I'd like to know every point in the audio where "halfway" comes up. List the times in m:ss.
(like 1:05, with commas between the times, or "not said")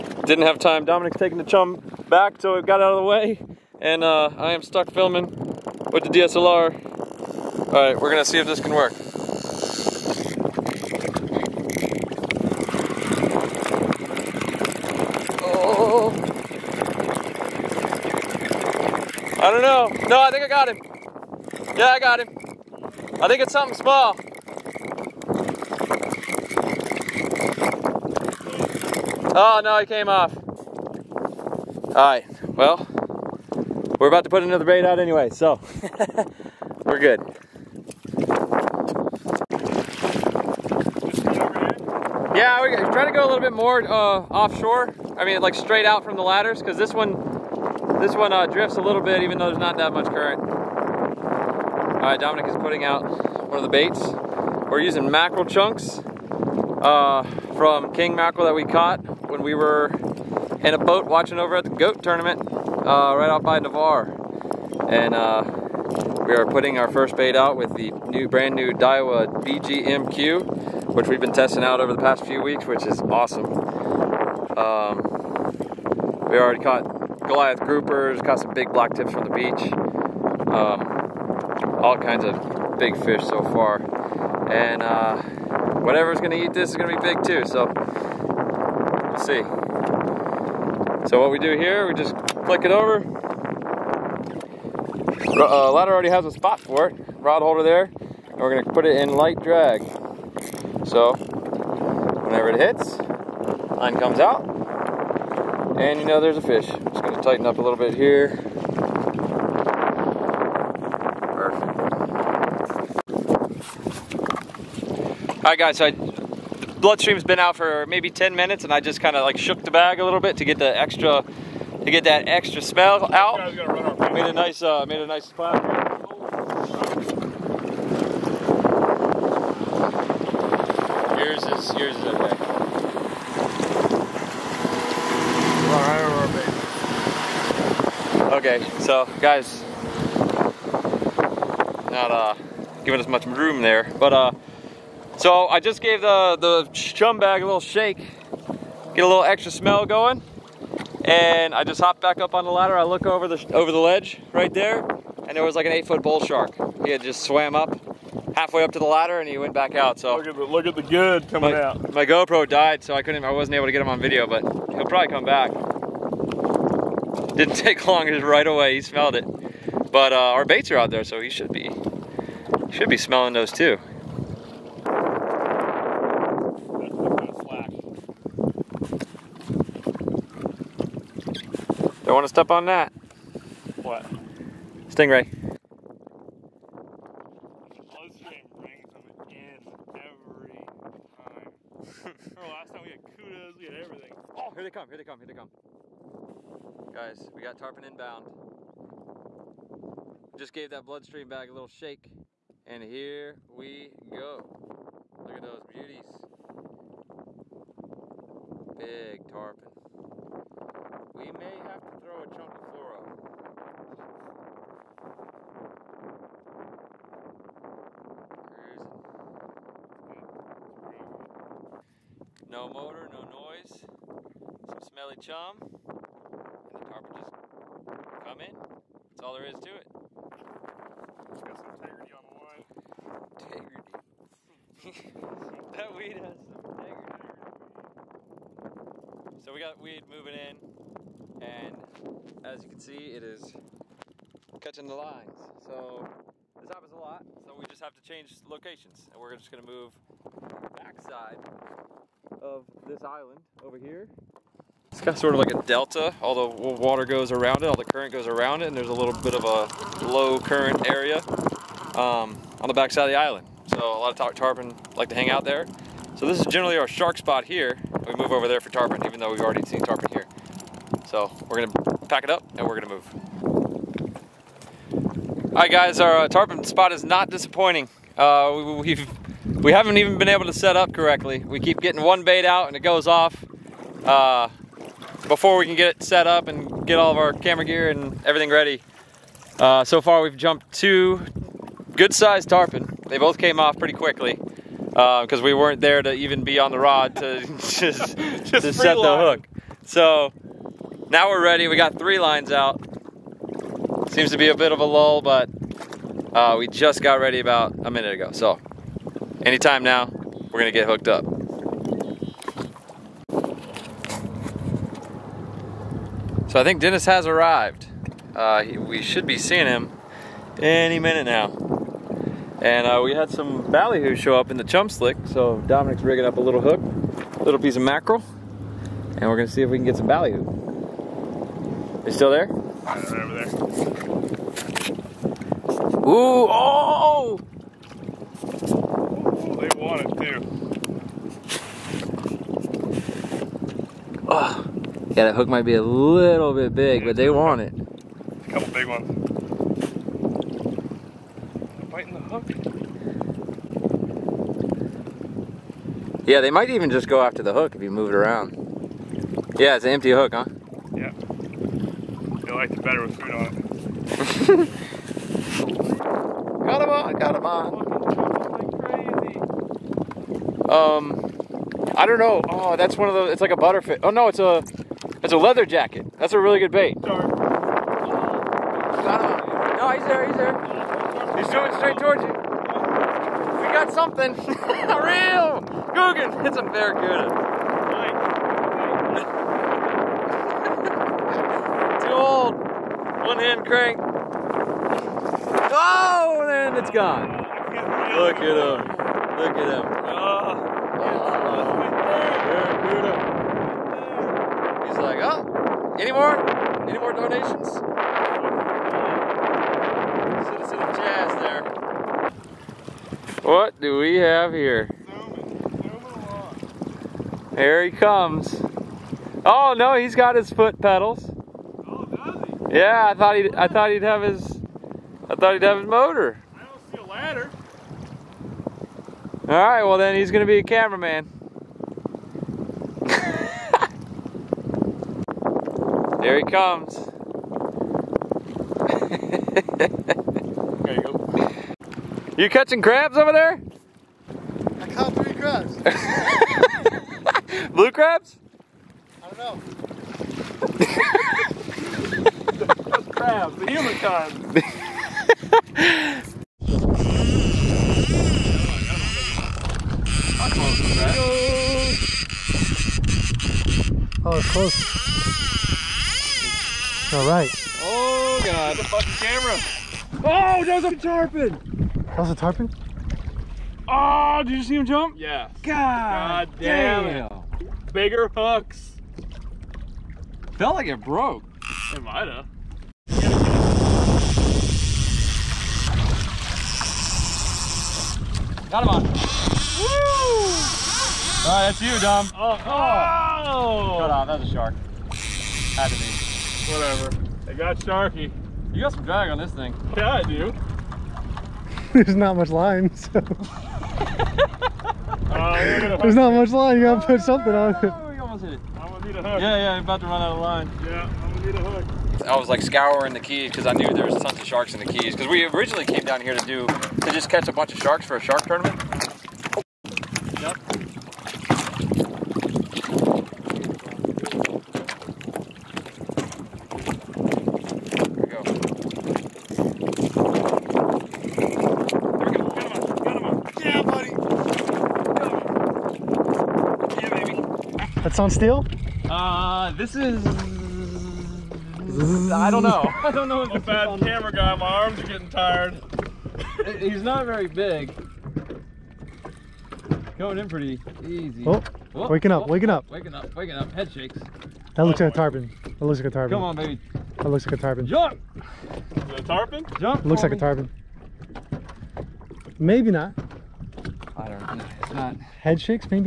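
2:38.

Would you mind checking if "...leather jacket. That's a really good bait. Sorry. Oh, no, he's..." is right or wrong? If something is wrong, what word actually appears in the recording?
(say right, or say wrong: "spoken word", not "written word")
right.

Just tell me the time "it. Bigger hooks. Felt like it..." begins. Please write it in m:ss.
7:57.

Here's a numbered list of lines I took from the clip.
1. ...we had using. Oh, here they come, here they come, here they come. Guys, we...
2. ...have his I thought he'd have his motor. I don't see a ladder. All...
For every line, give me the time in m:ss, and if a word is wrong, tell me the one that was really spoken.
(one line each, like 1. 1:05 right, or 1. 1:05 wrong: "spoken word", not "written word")
1. 3:13 wrong: "everything", not "using"
2. 7:04 right.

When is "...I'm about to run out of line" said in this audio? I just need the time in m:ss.
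8:29.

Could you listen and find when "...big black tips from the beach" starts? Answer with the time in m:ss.
1:18.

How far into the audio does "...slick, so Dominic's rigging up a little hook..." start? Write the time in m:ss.
5:24.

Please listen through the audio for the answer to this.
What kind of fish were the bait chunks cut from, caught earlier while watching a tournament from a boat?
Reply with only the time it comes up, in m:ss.
0:57.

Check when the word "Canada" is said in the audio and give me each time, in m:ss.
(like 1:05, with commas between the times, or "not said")
not said.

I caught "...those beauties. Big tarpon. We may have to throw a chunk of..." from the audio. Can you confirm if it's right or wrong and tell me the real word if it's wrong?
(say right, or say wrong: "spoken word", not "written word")
right.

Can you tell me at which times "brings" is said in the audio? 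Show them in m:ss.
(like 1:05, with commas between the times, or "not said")
3:08.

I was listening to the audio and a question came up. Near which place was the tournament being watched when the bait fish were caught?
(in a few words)
Navarre.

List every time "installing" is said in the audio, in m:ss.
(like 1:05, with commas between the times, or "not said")
not said.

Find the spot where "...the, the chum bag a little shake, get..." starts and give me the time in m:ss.
2:26.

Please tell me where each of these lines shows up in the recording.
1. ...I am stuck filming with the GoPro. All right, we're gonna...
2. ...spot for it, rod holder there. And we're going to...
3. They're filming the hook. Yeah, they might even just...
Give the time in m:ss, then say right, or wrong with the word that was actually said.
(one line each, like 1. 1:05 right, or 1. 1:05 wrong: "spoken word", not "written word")
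1. 0:04 wrong: "DSLR", not "GoPro"
2. 1:36 right
3. 5:51 wrong: "biting", not "filming".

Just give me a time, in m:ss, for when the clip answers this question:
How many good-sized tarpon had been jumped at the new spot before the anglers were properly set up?
4:50.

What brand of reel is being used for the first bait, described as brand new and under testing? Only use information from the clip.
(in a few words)
Daiwa.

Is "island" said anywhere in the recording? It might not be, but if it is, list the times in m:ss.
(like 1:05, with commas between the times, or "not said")
4:13, 4:23.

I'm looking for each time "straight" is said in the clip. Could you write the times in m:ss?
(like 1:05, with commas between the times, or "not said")
0:45, 6:21.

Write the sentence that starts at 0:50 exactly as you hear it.
All right, Dominic is putting out one of the baits.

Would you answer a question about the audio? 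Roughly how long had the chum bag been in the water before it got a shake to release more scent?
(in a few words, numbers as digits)
10 minutes.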